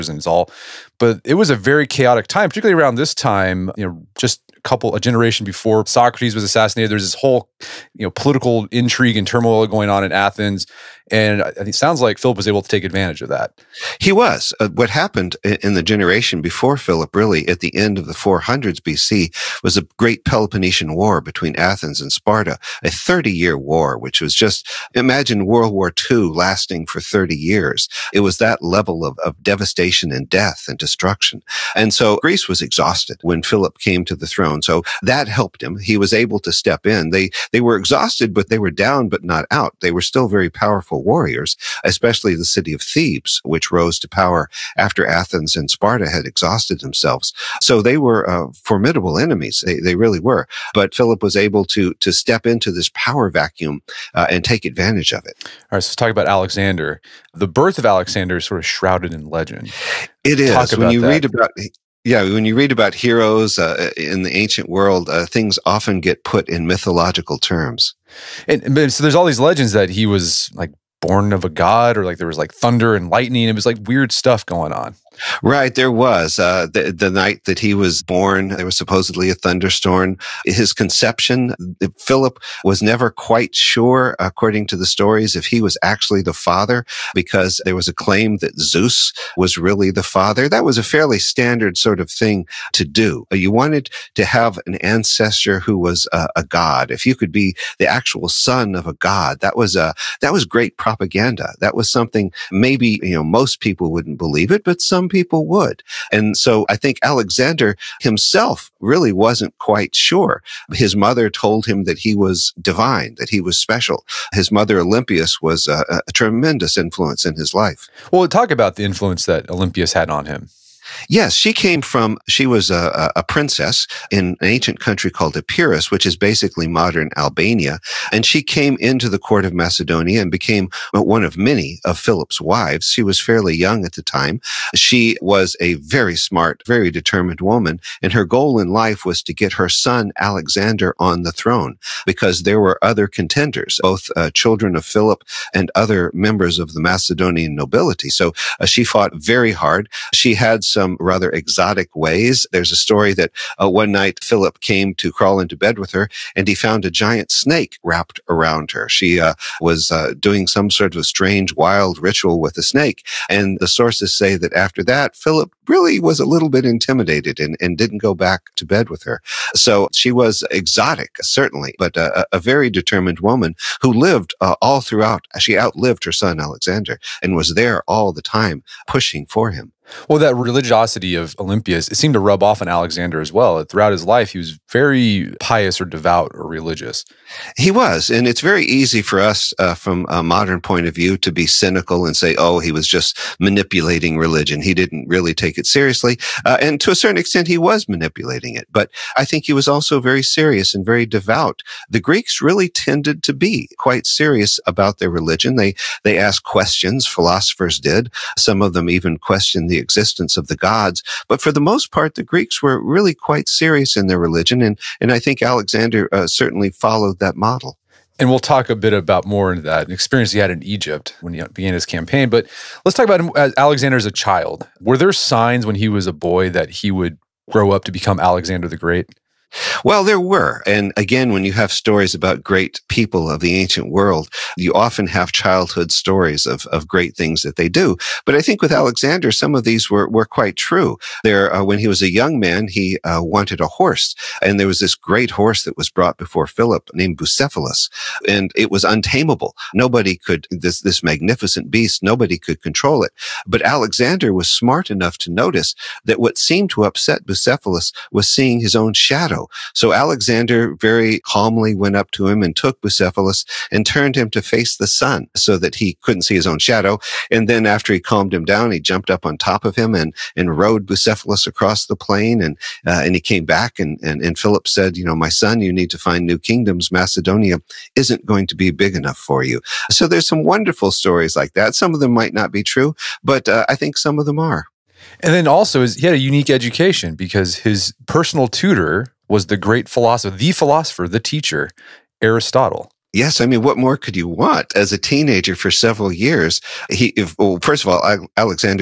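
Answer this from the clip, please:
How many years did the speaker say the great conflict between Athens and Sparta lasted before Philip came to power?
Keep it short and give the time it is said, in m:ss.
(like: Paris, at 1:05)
30, at 0:22.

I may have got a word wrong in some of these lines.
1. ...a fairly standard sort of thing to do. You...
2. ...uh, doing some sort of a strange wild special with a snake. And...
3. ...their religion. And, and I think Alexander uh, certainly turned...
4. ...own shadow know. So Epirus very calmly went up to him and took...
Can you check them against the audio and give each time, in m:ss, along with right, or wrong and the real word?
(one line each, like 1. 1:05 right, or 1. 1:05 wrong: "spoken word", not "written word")
1. 1:30 right
2. 2:39 wrong: "ritual", not "special"
3. 3:34 wrong: "followed", not "turned"
4. 4:18 wrong: "Alexander", not "Epirus".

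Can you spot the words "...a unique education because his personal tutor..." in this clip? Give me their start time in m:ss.
4:46.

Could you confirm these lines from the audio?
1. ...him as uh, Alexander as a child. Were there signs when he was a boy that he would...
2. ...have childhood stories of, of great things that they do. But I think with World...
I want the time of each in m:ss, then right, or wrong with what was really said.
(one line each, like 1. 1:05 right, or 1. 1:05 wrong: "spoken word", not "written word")
1. 3:43 right
2. 3:55 wrong: "Alexander", not "World".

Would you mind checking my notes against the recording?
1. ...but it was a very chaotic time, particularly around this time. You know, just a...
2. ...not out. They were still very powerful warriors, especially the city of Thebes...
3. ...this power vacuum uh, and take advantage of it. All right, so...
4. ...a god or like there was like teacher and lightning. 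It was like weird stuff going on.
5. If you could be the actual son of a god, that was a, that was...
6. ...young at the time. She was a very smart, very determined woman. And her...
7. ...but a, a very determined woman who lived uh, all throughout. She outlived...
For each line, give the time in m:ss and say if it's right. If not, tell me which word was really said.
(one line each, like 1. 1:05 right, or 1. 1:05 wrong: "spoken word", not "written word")
1. 0:00 right
2. 0:39 right
3. 0:52 right
4. 1:11 wrong: "thunder", not "teacher"
5. 1:36 right
6. 2:13 right
7. 2:51 right.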